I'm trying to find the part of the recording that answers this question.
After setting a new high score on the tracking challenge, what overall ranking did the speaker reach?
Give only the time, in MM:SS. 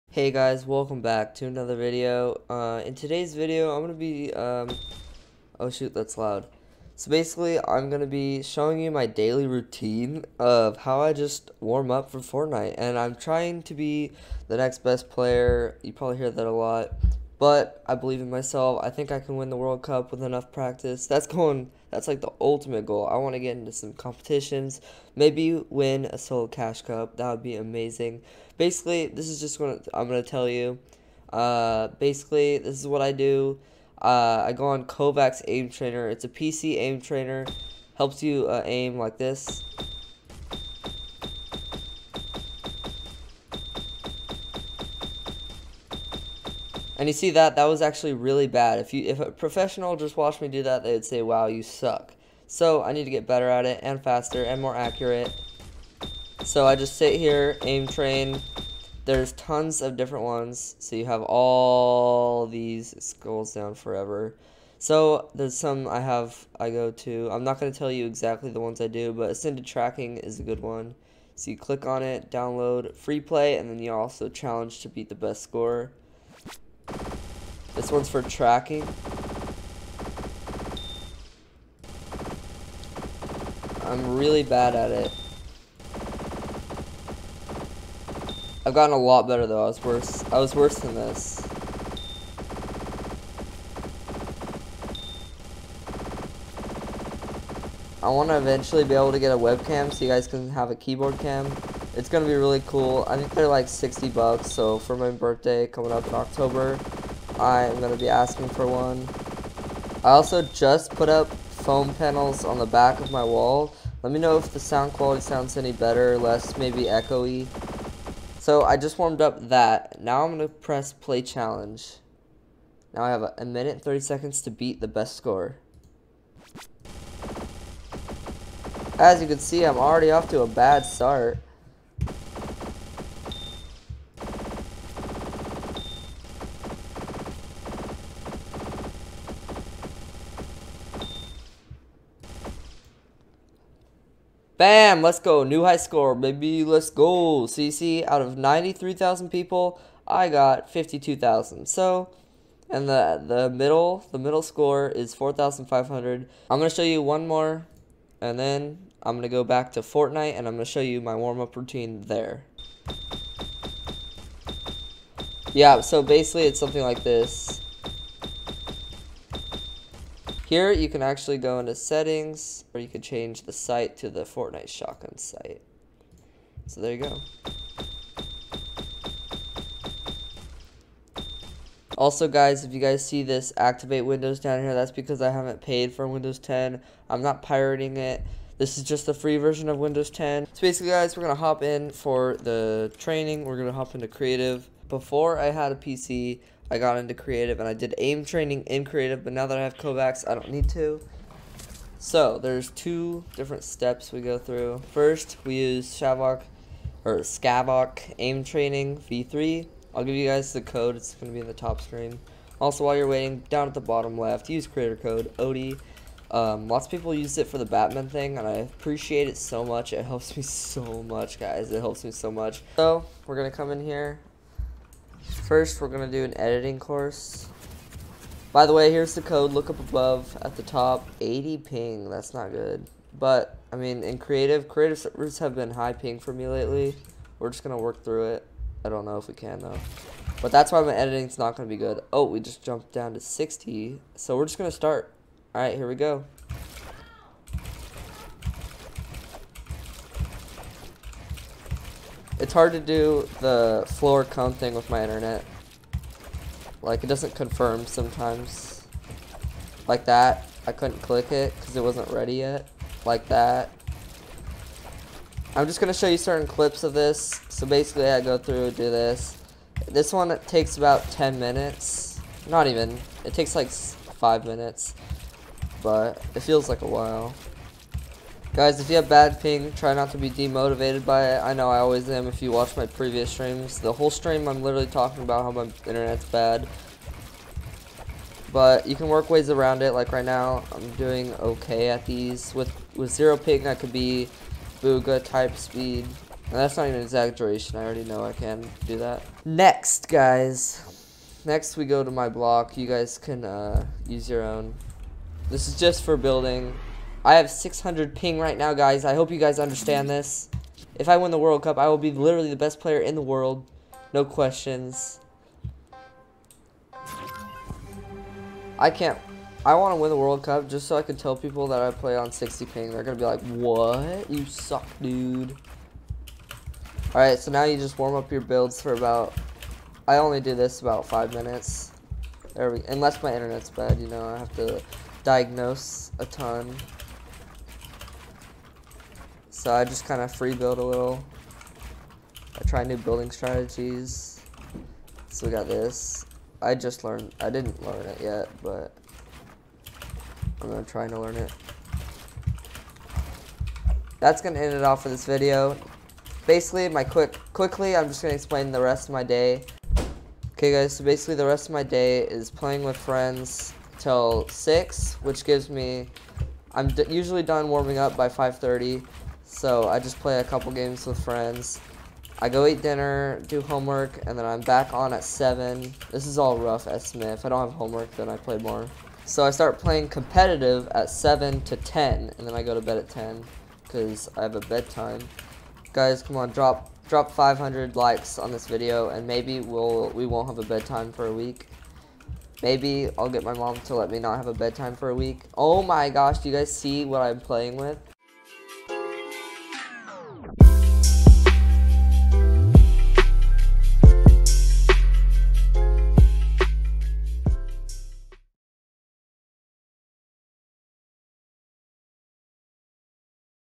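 02:30.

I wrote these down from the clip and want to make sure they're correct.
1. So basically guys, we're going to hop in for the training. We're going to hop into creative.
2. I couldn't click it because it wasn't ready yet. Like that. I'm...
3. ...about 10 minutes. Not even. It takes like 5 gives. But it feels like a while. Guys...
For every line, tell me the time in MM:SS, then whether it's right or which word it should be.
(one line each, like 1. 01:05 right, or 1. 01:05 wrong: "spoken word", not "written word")
1. 03:10 right
2. 04:20 right
3. 04:30 wrong: "minutes", not "gives".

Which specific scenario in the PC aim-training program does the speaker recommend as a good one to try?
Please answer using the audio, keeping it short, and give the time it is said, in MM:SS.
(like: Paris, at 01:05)
ascended tracking, at 01:09.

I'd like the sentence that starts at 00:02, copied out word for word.
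Uh, in today's video, I'm going to be, um, oh shoot, that's loud.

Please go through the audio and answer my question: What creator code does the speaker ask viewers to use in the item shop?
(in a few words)
odie.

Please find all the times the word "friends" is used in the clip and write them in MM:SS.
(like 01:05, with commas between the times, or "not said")
06:02, 06:11.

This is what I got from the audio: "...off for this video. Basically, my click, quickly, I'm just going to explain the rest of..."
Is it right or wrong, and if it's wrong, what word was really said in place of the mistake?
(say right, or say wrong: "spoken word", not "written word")
wrong: "quick", not "click".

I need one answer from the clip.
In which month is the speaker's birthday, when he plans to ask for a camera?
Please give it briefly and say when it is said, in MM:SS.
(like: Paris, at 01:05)
October, at 01:46.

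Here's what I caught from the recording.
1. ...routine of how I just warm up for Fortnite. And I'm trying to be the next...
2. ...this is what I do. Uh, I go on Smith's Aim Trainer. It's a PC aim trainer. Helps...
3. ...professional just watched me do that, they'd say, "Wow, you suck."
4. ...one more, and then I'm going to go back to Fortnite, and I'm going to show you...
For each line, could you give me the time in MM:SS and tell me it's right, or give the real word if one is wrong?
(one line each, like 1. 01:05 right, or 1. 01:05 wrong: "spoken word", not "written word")
1. 00:09 right
2. 00:32 wrong: "Kovaak", not "Smith"
3. 00:49 right
4. 02:37 right.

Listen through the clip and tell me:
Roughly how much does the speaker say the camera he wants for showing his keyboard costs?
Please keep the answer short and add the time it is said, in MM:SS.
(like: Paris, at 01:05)
60 bucks, at 01:43.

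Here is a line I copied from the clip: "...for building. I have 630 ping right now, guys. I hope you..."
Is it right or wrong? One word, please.
wrong.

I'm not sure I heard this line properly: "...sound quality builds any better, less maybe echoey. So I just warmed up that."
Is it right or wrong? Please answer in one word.
wrong.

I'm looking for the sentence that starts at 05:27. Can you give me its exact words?
Alright, so now you just warm up your builds for about...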